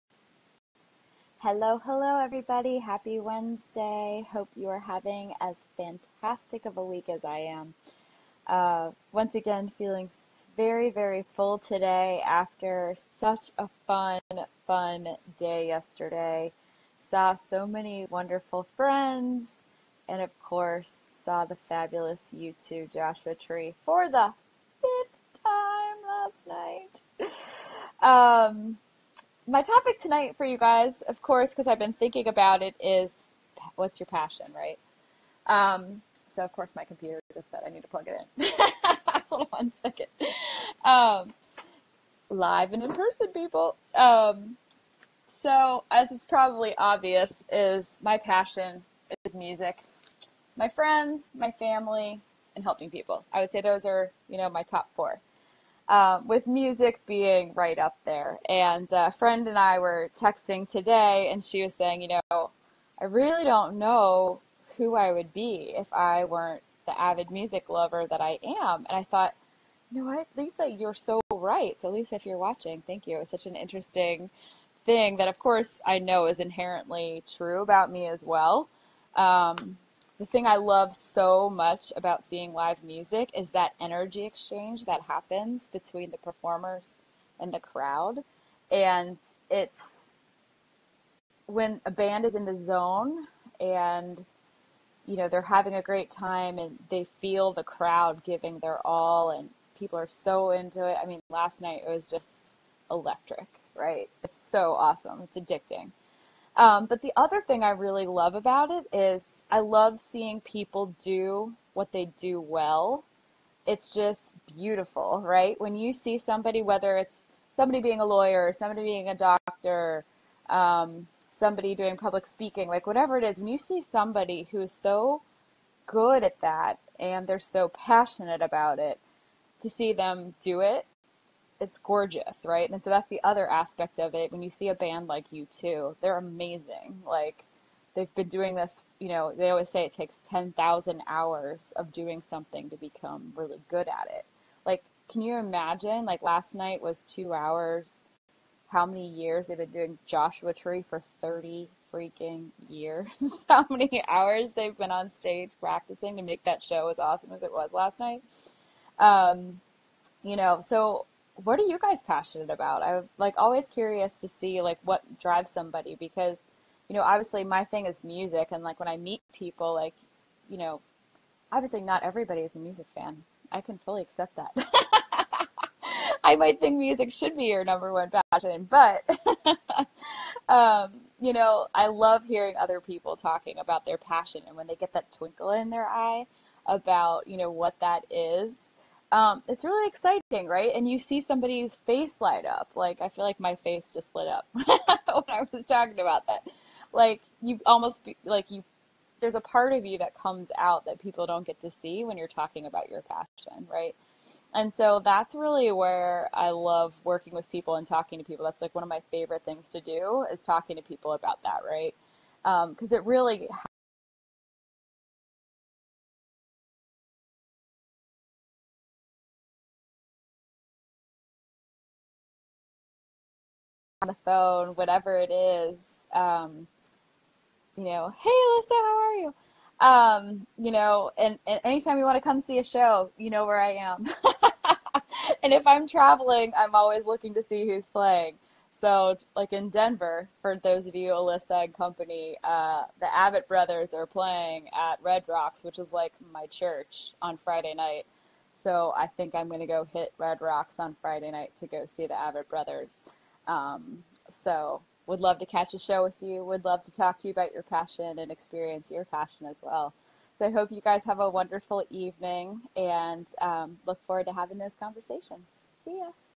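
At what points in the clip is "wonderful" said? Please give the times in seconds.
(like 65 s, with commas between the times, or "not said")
18 s, 261 s.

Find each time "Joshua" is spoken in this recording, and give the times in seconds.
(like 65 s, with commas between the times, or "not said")
22 s, 150 s.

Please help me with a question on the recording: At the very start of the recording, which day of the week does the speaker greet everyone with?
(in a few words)
Wednesday.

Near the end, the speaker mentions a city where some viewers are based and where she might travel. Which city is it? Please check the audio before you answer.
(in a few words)
Denver.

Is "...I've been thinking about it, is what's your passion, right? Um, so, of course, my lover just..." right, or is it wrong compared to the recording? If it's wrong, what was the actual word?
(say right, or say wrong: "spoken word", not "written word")
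wrong: "computer", not "lover".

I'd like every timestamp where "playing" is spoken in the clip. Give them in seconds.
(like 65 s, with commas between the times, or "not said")
237 s, 244 s.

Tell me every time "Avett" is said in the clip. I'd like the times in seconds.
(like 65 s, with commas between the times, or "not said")
243 s, 252 s.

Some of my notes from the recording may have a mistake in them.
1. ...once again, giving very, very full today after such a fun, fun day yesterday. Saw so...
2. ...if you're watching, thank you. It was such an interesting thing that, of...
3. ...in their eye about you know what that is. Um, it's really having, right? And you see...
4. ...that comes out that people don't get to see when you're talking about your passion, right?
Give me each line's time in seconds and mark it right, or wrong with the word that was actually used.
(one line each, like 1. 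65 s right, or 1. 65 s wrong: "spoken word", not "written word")
1. 9 s wrong: "feeling", not "giving"
2. 72 s right
3. 185 s wrong: "exciting", not "having"
4. 199 s right.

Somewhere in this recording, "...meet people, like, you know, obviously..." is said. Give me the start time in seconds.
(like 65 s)
168 s.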